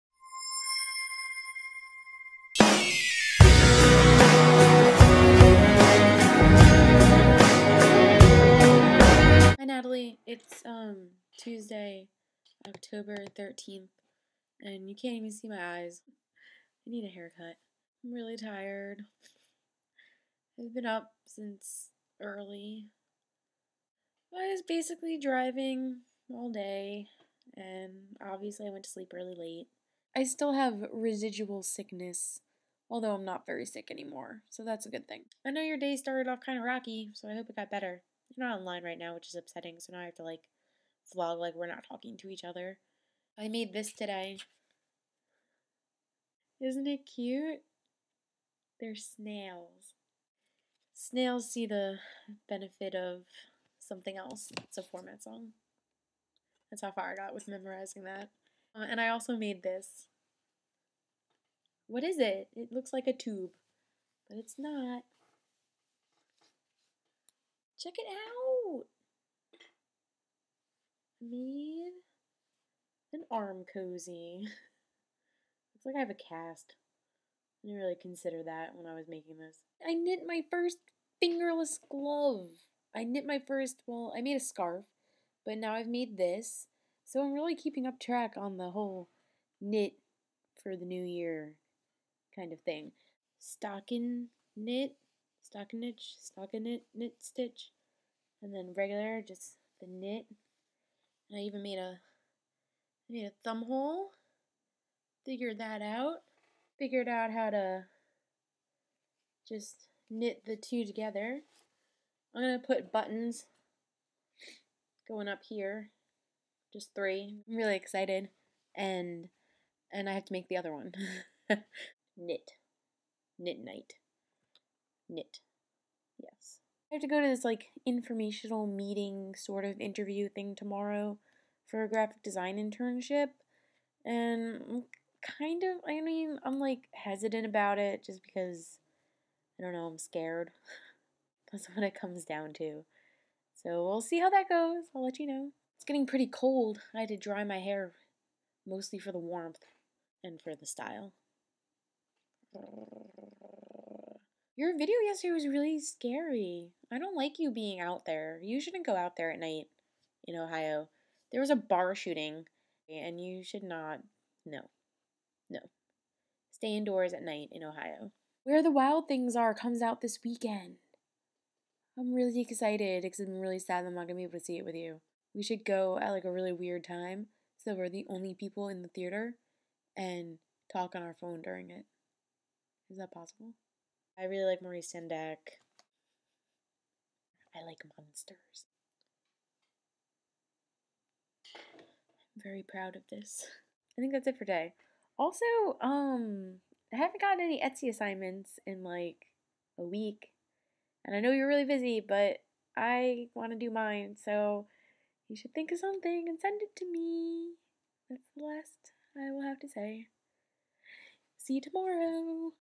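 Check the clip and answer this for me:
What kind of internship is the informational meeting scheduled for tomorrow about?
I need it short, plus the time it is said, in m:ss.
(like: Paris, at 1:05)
Graphic design, at 2:11.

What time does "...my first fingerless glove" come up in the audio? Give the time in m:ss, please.
1:20.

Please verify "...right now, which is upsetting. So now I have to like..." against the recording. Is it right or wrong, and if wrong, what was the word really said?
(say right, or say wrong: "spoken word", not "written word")
right.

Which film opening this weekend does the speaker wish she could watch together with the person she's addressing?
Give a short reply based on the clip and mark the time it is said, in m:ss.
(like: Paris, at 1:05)
Where the Wild Things Are, at 2:48.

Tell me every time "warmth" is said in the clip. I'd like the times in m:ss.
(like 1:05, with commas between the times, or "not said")
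2:29.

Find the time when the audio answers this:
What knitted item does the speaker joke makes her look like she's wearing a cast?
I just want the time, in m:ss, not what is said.
1:13.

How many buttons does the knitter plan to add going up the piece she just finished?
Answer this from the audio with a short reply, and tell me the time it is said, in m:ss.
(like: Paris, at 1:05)
3, at 1:56.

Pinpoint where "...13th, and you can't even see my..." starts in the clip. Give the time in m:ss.
0:13.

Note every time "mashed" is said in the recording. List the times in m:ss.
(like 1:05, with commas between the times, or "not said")
not said.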